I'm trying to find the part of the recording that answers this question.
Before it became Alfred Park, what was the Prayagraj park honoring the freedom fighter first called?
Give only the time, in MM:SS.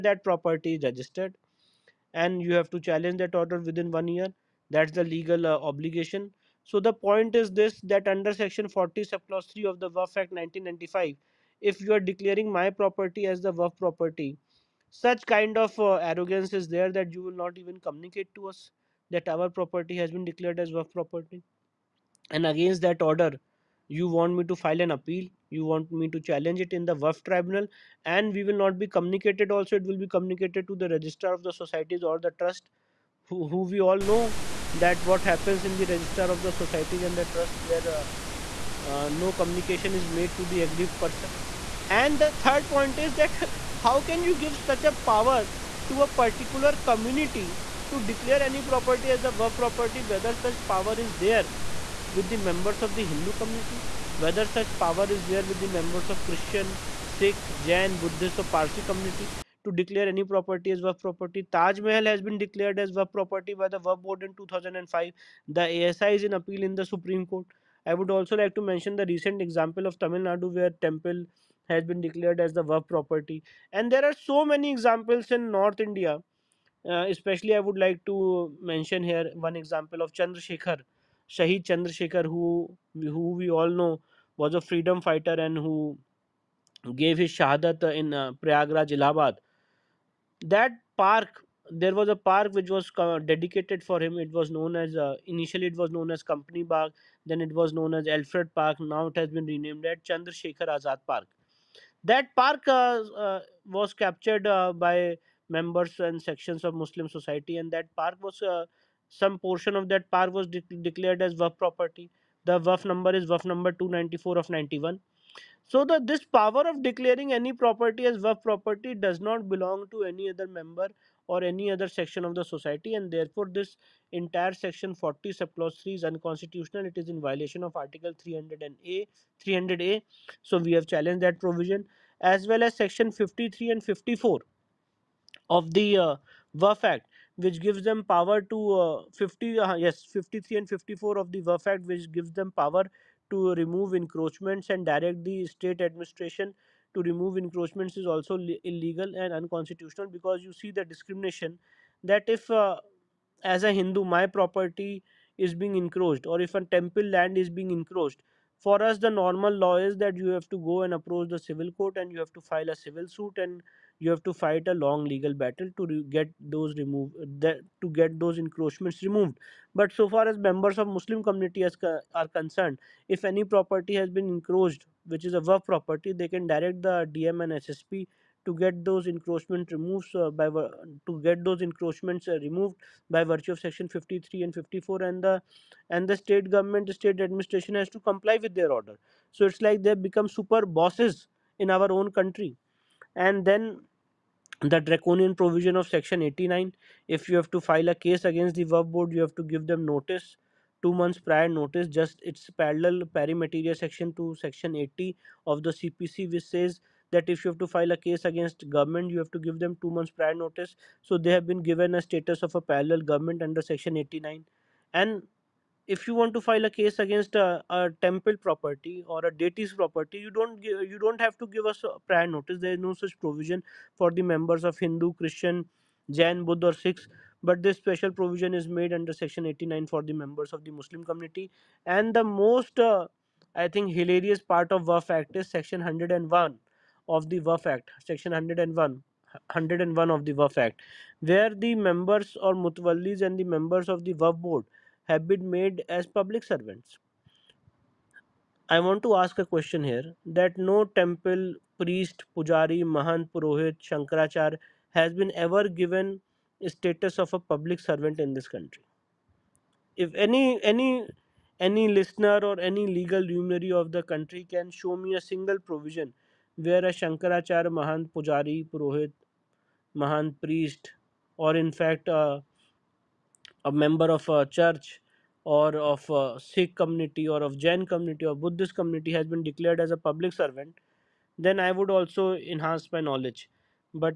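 01:36.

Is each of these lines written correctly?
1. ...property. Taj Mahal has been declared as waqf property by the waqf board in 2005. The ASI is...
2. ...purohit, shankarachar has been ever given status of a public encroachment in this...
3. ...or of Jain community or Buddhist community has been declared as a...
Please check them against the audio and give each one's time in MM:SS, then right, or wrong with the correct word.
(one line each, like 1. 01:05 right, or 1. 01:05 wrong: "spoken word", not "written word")
1. 01:01 right
2. 04:13 wrong: "servant", not "encroachment"
3. 04:37 right.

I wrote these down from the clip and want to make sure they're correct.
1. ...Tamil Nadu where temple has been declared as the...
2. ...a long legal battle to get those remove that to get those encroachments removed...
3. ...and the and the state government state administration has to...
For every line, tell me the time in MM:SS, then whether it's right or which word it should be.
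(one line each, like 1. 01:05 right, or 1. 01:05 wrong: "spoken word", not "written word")
1. 01:09 right
2. 02:44 right
3. 03:05 right.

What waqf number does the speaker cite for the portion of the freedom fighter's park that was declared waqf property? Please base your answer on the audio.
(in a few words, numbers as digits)
294 of 91.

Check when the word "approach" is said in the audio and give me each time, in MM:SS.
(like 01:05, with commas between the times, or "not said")
02:40.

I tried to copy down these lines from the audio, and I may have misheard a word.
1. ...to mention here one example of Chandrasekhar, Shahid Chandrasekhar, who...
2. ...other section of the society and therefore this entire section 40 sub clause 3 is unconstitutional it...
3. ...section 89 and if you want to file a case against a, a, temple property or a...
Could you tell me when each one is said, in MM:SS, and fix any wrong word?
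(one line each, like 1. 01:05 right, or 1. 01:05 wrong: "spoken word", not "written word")
1. 01:18 right
2. 02:01 right
3. 03:33 right.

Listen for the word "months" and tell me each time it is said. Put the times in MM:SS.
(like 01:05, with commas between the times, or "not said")
03:20, 03:29.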